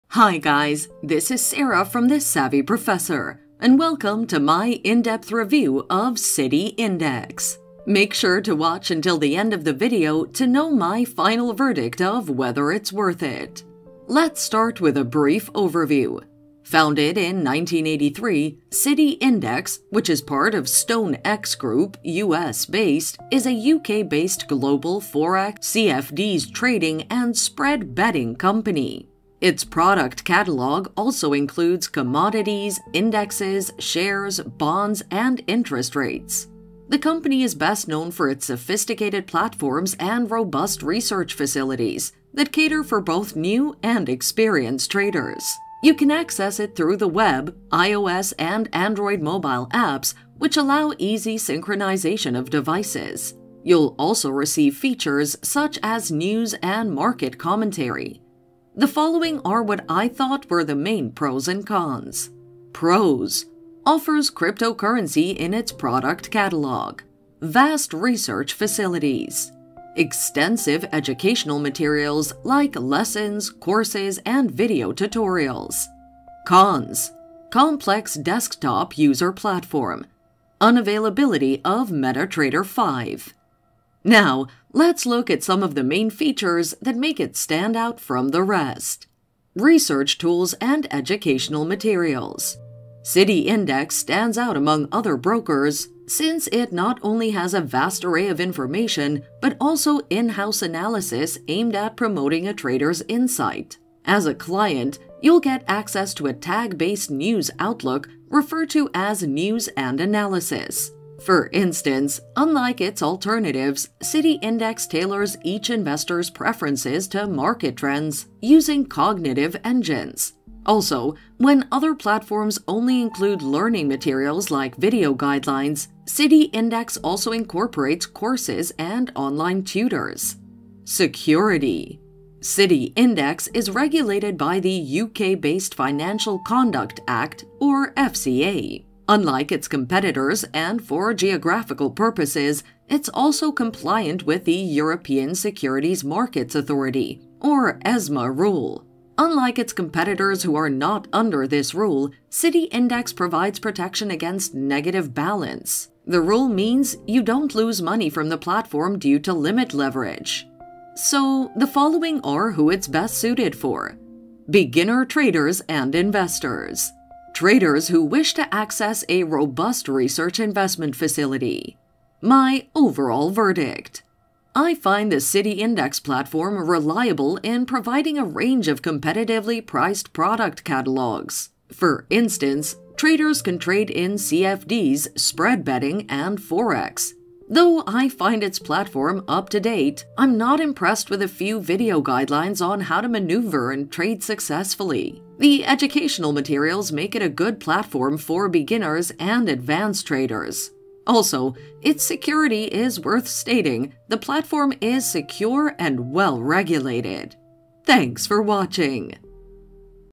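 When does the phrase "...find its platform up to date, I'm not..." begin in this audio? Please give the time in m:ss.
3:08.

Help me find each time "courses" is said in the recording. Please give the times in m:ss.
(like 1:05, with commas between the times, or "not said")
1:13, 2:08.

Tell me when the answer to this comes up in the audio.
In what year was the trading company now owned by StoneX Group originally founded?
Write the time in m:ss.
0:17.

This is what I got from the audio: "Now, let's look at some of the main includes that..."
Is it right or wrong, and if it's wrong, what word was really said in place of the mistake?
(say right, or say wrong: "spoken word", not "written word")
wrong: "features", not "includes".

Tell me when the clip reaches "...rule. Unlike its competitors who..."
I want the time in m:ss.
2:28.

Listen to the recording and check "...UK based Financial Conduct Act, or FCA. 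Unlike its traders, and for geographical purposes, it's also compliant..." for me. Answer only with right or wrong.
wrong.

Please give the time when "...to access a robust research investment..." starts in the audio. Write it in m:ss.
2:48.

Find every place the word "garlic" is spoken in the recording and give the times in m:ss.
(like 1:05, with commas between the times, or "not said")
not said.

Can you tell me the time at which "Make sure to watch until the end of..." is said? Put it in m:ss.
0:07.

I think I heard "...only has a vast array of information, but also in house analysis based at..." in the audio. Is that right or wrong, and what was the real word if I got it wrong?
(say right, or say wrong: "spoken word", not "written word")
wrong: "aimed", not "based".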